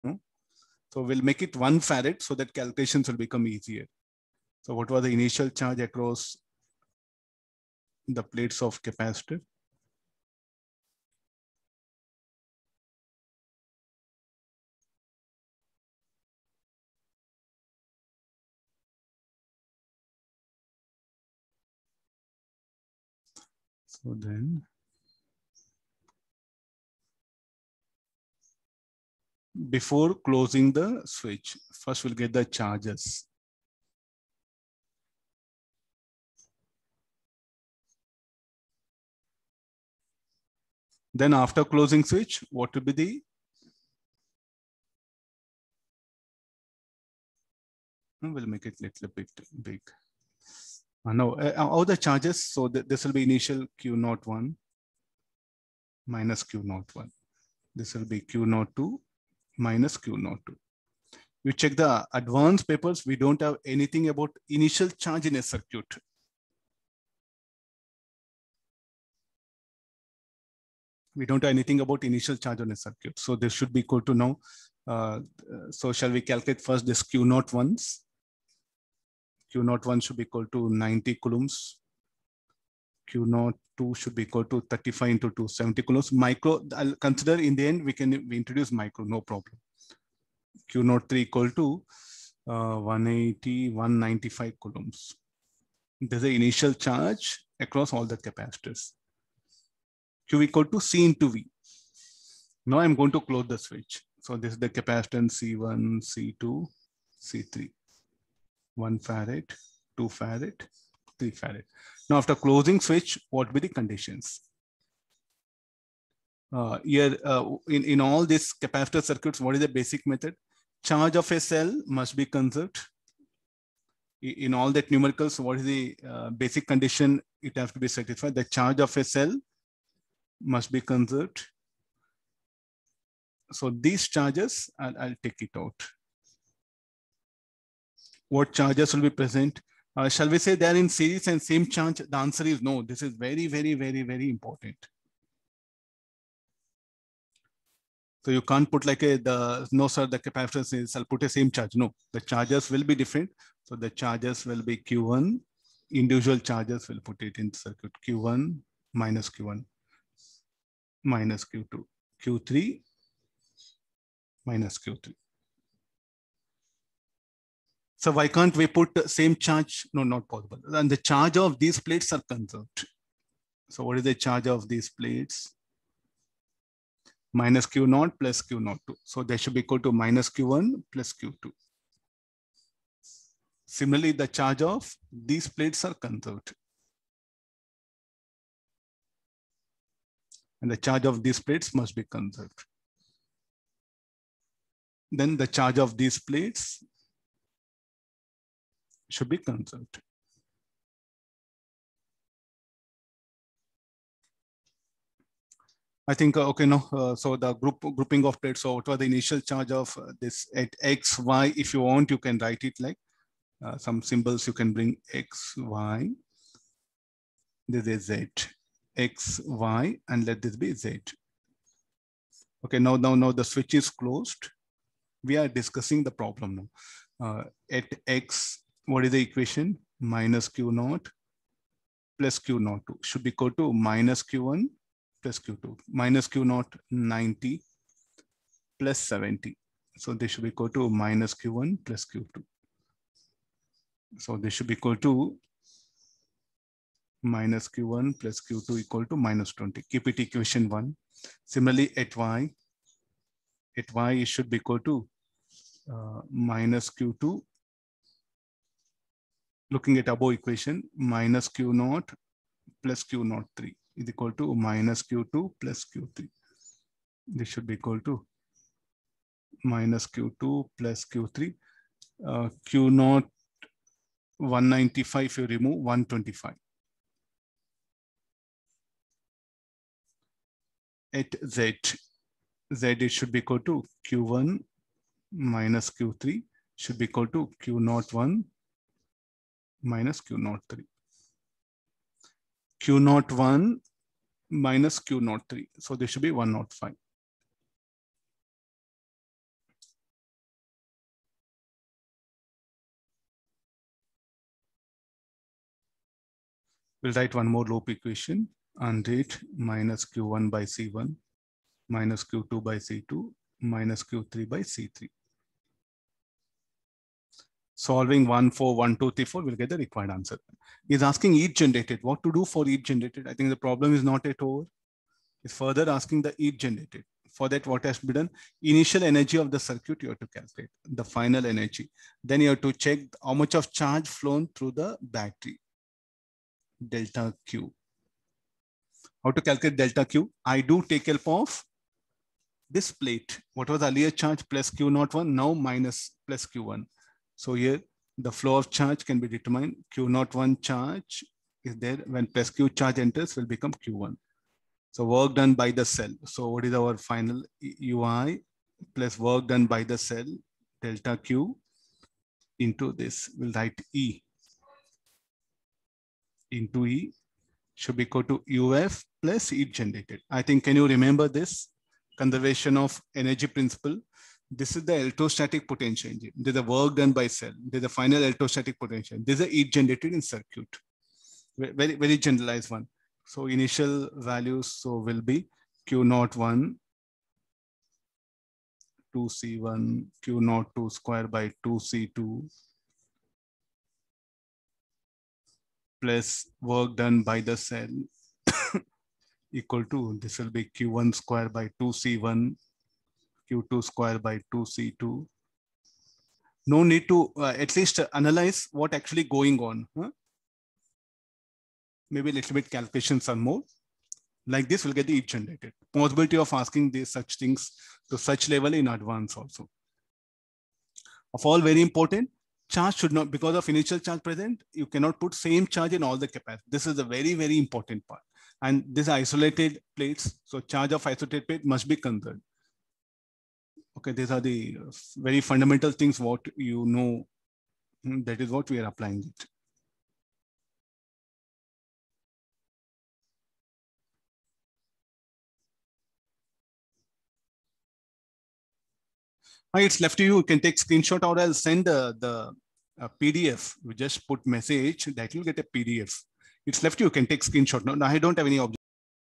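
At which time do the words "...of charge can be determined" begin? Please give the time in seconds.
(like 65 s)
348 s.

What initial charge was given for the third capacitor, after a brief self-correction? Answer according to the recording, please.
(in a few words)
195 coulombs.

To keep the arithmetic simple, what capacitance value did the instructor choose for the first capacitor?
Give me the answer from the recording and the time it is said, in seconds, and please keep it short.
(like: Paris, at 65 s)
1 farad, at 1 s.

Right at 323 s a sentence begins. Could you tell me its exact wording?
I think the problem is not yet over.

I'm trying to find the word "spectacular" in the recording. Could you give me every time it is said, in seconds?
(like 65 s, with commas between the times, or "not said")
not said.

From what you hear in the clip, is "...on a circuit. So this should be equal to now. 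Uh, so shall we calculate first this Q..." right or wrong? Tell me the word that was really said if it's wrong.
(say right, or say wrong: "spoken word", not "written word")
right.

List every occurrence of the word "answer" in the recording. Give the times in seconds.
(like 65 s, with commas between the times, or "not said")
142 s, 320 s.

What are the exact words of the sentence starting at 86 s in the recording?
Micro, I'll consider in the end, we can we introduce micro, no problem.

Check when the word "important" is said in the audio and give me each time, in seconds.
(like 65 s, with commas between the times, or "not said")
144 s, 421 s, 427 s.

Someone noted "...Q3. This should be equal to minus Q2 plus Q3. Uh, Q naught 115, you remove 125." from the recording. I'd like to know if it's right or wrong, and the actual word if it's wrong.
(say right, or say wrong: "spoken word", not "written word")
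wrong: "195", not "115".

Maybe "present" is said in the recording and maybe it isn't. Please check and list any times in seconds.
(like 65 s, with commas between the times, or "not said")
139 s, 424 s.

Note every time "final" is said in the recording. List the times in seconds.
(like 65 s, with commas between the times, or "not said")
331 s, 356 s, 377 s.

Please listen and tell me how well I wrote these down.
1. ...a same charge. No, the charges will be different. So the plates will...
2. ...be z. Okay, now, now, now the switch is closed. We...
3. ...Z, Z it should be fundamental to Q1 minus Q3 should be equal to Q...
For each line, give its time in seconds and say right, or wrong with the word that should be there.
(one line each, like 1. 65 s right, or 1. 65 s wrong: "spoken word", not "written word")
1. 151 s wrong: "charges", not "plates"
2. 220 s right
3. 281 s wrong: "equal", not "fundamental".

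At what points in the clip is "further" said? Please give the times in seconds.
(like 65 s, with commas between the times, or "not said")
325 s.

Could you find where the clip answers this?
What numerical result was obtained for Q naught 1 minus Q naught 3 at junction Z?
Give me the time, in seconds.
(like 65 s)
296 s.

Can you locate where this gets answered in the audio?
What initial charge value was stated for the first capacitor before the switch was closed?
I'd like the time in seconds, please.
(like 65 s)
80 s.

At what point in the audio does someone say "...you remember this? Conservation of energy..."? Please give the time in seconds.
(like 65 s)
370 s.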